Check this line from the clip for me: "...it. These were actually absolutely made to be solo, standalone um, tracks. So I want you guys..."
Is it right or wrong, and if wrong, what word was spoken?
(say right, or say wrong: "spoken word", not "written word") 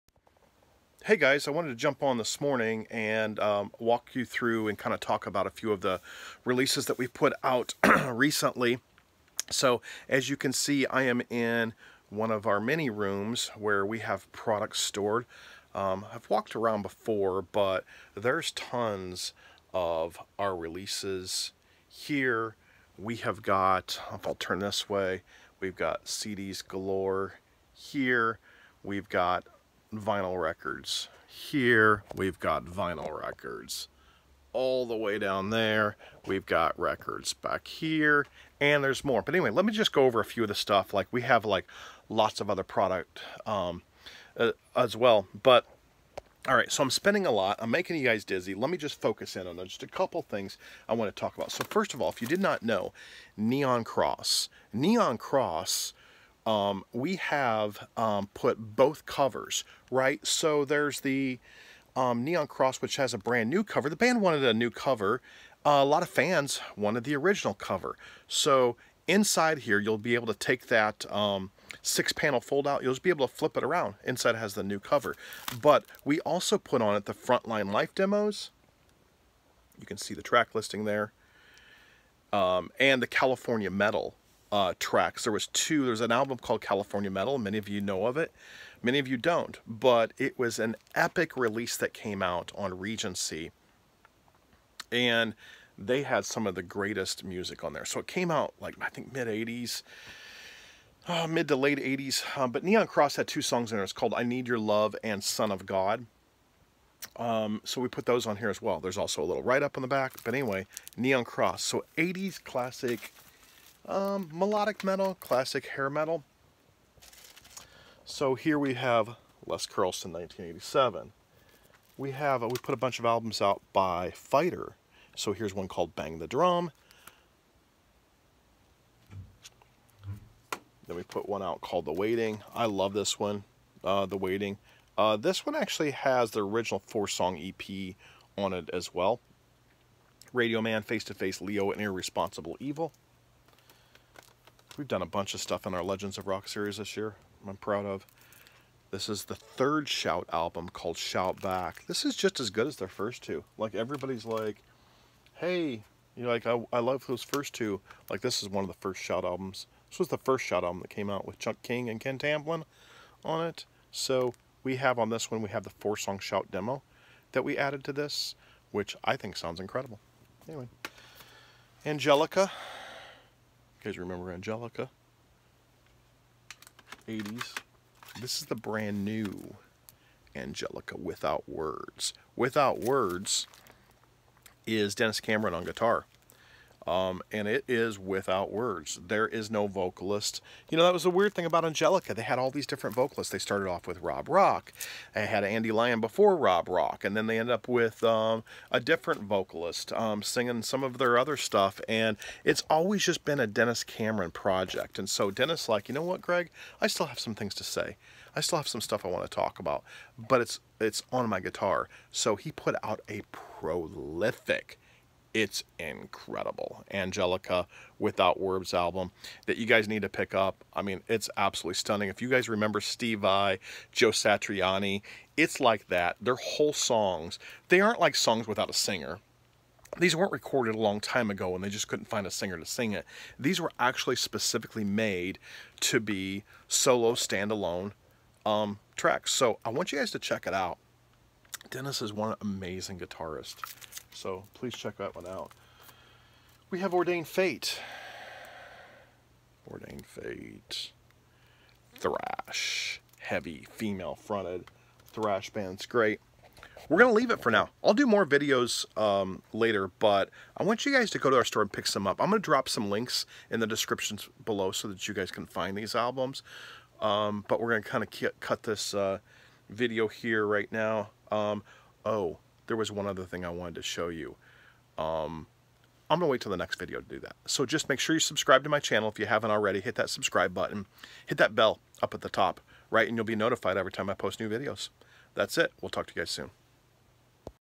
wrong: "specifically", not "absolutely".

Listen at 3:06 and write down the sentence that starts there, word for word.
Um, and it is without words.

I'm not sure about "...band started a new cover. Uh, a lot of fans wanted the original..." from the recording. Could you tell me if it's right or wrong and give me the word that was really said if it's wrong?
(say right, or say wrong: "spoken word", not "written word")
wrong: "wanted", not "started".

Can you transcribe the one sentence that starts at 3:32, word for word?
So he put out a prolific it's incredible.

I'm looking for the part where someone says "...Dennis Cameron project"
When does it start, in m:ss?
3:23.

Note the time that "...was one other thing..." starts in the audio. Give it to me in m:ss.
4:32.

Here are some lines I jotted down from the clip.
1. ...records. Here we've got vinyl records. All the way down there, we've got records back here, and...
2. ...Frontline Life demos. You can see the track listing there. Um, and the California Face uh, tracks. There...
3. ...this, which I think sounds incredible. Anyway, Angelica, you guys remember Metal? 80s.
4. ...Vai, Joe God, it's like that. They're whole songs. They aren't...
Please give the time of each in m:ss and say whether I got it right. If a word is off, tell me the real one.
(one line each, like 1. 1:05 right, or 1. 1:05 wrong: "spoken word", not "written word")
1. 0:30 right
2. 1:17 wrong: "Metal", not "Face"
3. 2:47 wrong: "Angelica", not "Metal"
4. 3:43 wrong: "Satriani", not "God".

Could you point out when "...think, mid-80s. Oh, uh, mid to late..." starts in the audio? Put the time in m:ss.
1:38.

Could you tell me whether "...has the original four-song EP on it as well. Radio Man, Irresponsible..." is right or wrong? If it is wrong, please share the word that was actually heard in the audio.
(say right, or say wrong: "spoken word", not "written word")
wrong: "Face", not "Irresponsible".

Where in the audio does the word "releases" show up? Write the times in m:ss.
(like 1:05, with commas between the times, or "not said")
0:06, 0:20, 1:31.